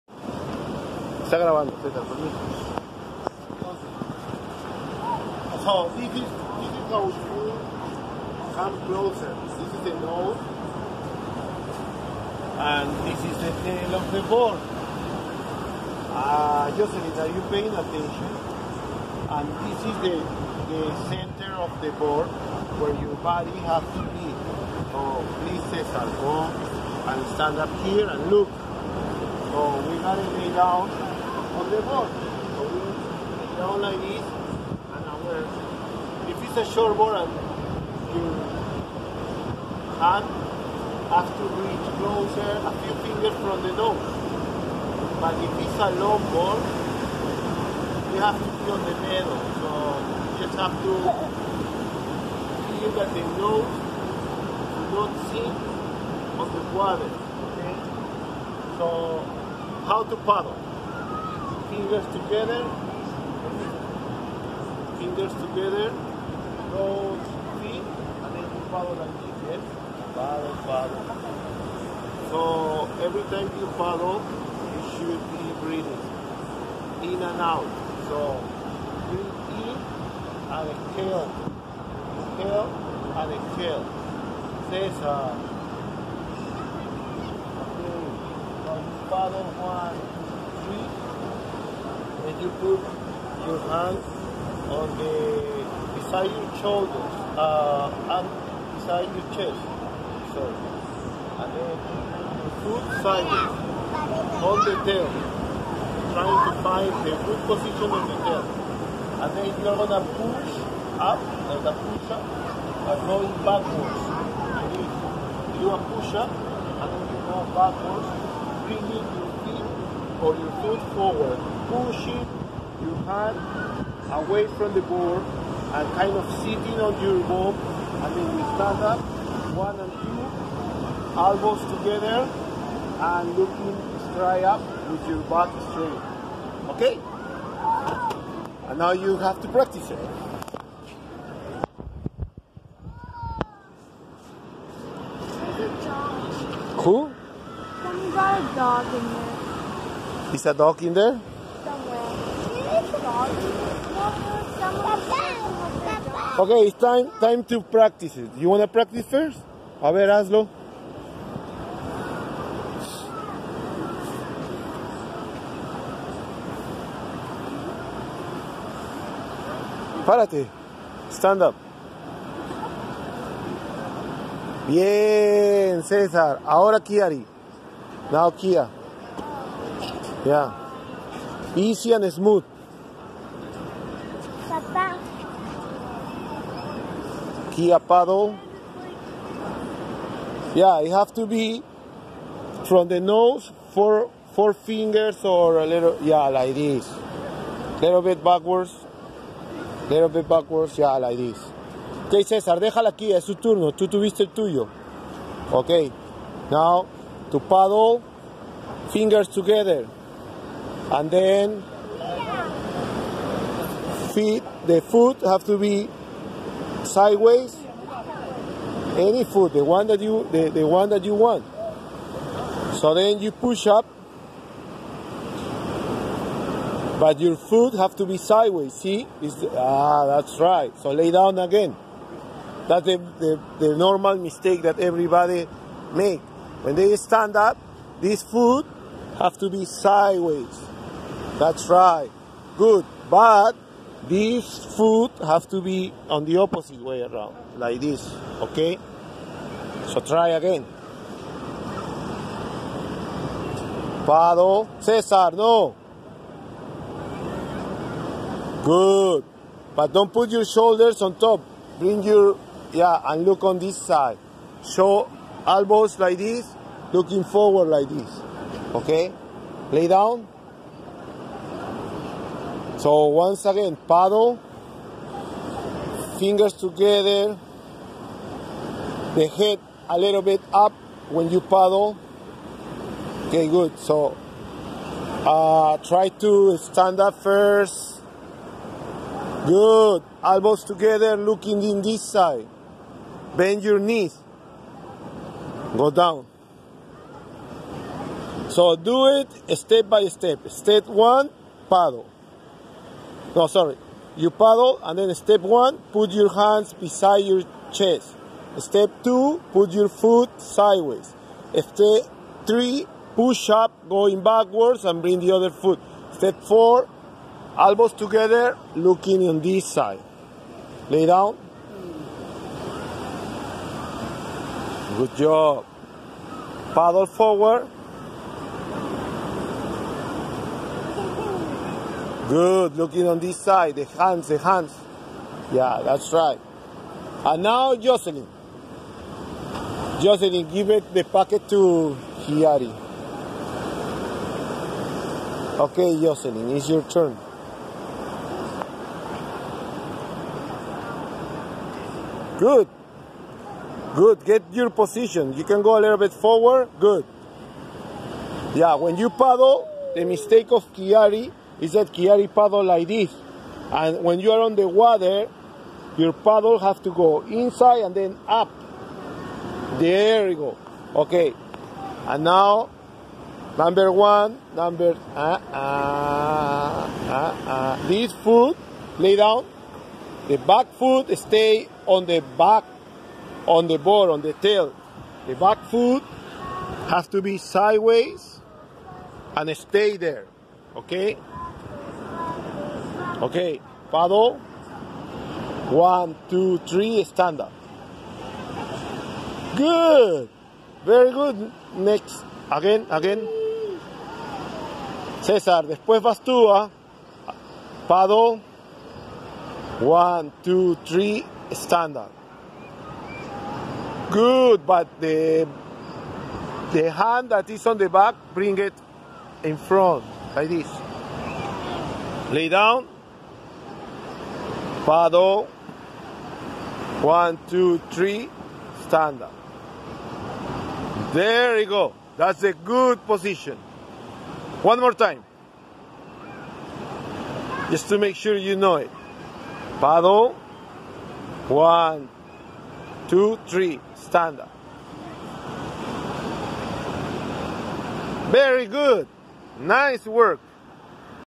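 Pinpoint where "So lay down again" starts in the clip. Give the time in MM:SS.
03:50.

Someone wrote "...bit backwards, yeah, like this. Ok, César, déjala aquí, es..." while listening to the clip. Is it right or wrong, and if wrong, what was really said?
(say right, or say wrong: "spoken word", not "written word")
right.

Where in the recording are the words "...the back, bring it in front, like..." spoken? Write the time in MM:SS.
06:57.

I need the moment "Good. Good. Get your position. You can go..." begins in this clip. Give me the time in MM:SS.
05:52.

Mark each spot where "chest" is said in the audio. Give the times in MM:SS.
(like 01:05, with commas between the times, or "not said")
01:39, 05:07.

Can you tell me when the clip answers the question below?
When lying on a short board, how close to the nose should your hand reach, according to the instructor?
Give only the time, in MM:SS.
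00:42.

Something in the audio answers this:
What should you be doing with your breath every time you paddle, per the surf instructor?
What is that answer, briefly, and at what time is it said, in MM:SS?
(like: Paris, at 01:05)
Breathing in and out, at 01:15.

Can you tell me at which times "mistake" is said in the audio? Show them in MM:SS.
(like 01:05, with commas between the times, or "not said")
03:54, 06:00.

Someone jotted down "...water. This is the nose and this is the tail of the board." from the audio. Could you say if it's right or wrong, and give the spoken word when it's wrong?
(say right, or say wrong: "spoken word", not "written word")
wrong: "closer", not "water".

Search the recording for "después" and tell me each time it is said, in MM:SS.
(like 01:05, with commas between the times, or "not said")
06:45.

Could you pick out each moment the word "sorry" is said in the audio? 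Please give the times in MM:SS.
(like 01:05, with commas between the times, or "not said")
05:03.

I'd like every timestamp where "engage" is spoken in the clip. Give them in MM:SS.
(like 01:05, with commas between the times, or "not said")
not said.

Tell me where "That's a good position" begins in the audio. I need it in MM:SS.
07:12.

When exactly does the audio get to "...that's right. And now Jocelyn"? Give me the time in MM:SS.
05:35.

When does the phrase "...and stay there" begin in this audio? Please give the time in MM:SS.
06:29.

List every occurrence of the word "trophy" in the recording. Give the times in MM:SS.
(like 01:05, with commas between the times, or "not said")
not said.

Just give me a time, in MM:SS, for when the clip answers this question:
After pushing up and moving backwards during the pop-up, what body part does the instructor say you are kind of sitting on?
02:06.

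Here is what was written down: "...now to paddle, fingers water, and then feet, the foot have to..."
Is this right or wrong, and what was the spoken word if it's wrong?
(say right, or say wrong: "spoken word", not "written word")
wrong: "together", not "water".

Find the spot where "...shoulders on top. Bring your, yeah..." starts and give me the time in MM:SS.
04:20.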